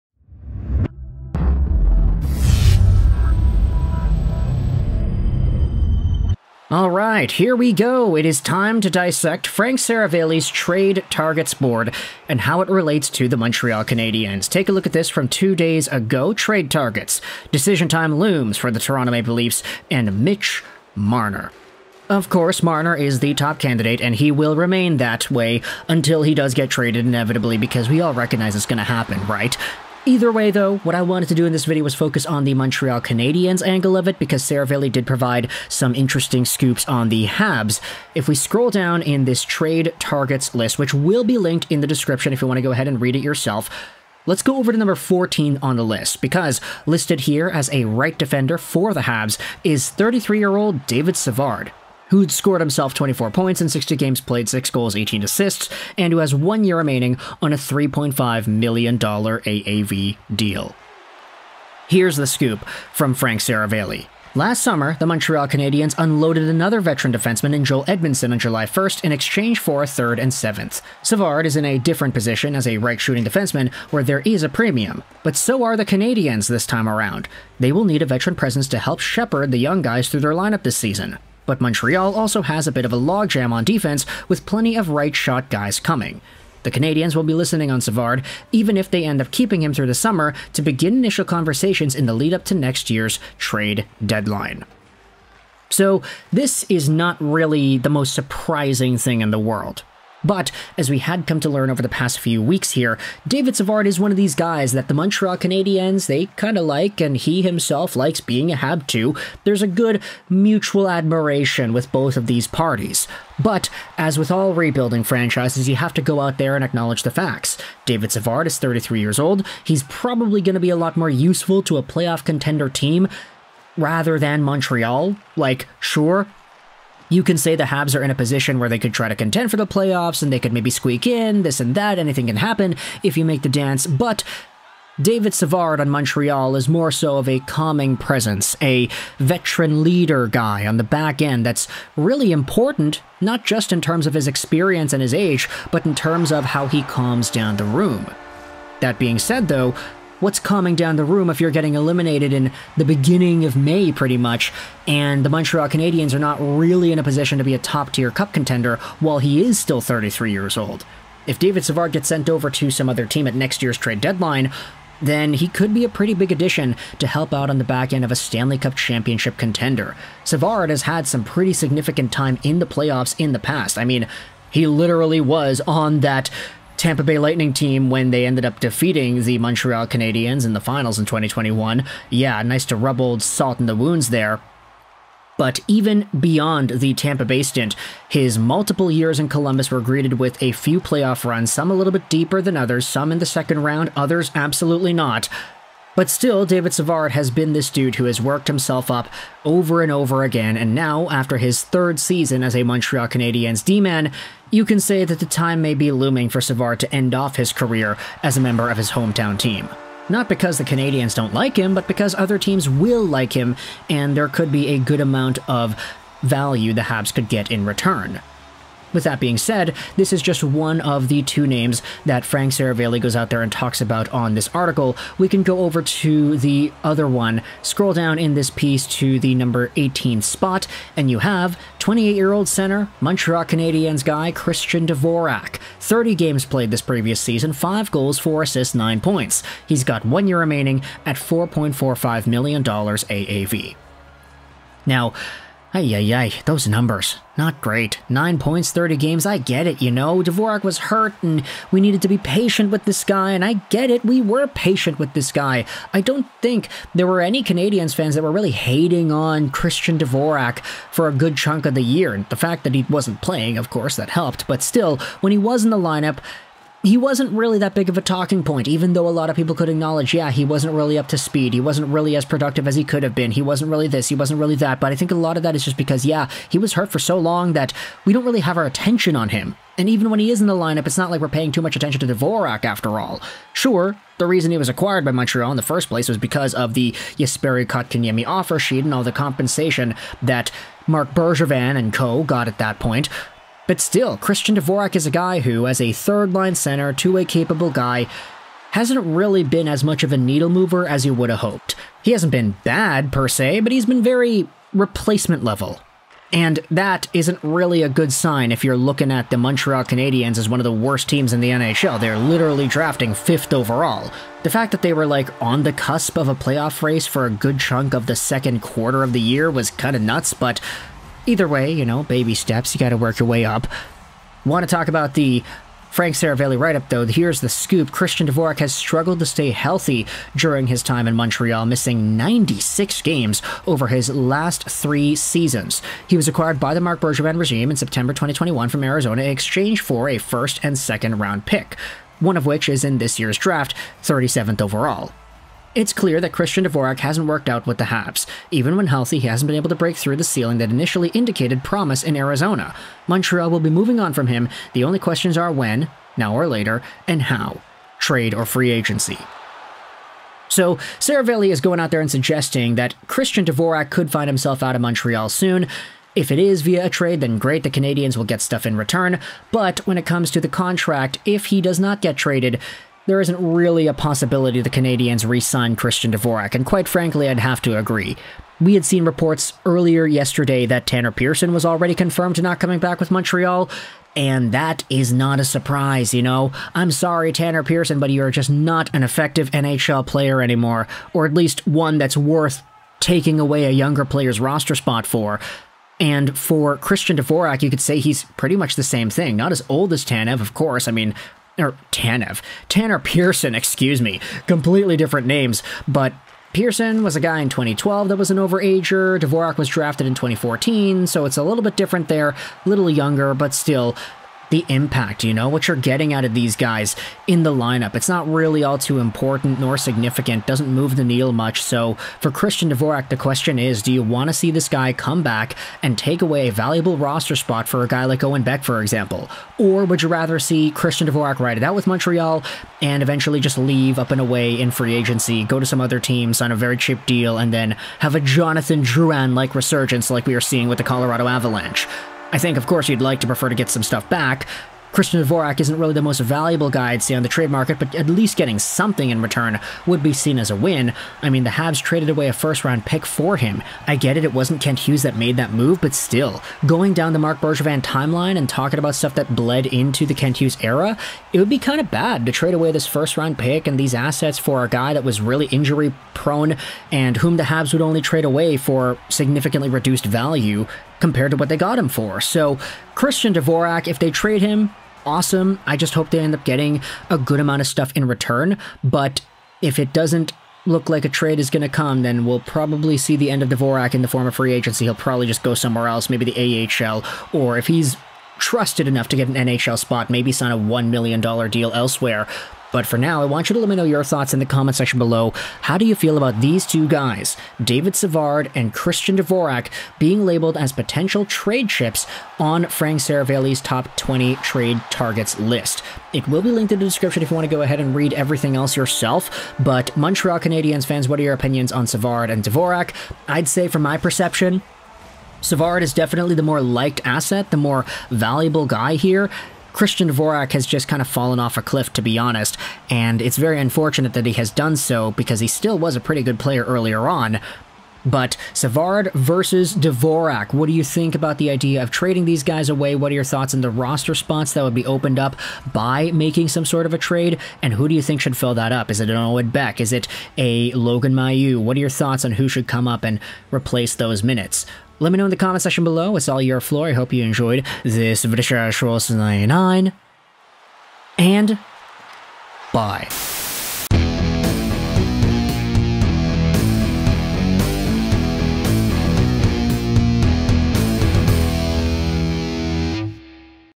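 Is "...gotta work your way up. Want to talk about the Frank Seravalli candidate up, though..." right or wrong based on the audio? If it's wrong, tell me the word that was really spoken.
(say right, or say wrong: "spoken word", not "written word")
wrong: "write", not "candidate".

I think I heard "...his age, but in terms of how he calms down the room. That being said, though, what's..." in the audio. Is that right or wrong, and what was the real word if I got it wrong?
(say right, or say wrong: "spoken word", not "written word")
right.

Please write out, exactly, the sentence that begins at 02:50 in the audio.
Savard has had some pretty significant time in the playoffs in the past.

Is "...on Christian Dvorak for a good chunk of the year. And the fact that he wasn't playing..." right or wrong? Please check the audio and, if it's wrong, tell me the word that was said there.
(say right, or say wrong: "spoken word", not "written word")
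right.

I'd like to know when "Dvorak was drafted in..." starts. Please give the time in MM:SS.
06:49.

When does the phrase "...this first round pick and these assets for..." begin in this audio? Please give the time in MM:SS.
07:42.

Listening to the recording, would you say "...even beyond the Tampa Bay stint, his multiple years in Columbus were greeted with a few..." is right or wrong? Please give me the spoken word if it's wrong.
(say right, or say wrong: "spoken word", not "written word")
right.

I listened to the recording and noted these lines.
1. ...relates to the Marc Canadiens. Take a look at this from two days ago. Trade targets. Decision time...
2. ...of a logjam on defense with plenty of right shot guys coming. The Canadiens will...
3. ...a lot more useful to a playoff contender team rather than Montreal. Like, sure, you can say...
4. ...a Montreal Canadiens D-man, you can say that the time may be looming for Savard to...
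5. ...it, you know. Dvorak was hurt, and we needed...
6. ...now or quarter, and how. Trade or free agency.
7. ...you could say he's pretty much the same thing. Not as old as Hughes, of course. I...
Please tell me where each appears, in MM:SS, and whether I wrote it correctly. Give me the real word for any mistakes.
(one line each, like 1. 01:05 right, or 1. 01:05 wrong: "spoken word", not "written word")
1. 00:12 wrong: "Montreal", not "Marc"
2. 01:22 right
3. 02:00 right
4. 03:22 right
5. 04:09 right
6. 05:56 wrong: "later", not "quarter"
7. 06:37 wrong: "Tanev", not "Hughes".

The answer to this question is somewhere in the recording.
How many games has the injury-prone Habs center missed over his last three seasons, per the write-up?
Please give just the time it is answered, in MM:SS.
05:32.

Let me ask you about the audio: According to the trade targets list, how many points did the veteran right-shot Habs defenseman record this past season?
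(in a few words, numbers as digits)
24.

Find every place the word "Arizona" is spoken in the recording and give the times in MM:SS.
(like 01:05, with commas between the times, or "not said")
05:38, 05:52.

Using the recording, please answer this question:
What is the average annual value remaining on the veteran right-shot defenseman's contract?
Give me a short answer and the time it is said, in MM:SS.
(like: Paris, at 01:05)
$3.5 million, at 00:57.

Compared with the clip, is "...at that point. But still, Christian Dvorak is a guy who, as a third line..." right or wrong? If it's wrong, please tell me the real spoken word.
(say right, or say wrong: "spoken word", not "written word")
right.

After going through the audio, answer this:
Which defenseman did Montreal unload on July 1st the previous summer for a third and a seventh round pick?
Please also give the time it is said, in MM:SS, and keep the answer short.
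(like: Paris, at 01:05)
Joel Edmundson, at 01:07.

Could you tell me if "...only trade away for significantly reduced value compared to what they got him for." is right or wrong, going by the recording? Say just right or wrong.
right.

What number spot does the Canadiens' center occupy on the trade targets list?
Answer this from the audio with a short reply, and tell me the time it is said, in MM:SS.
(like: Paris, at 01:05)
18, at 03:49.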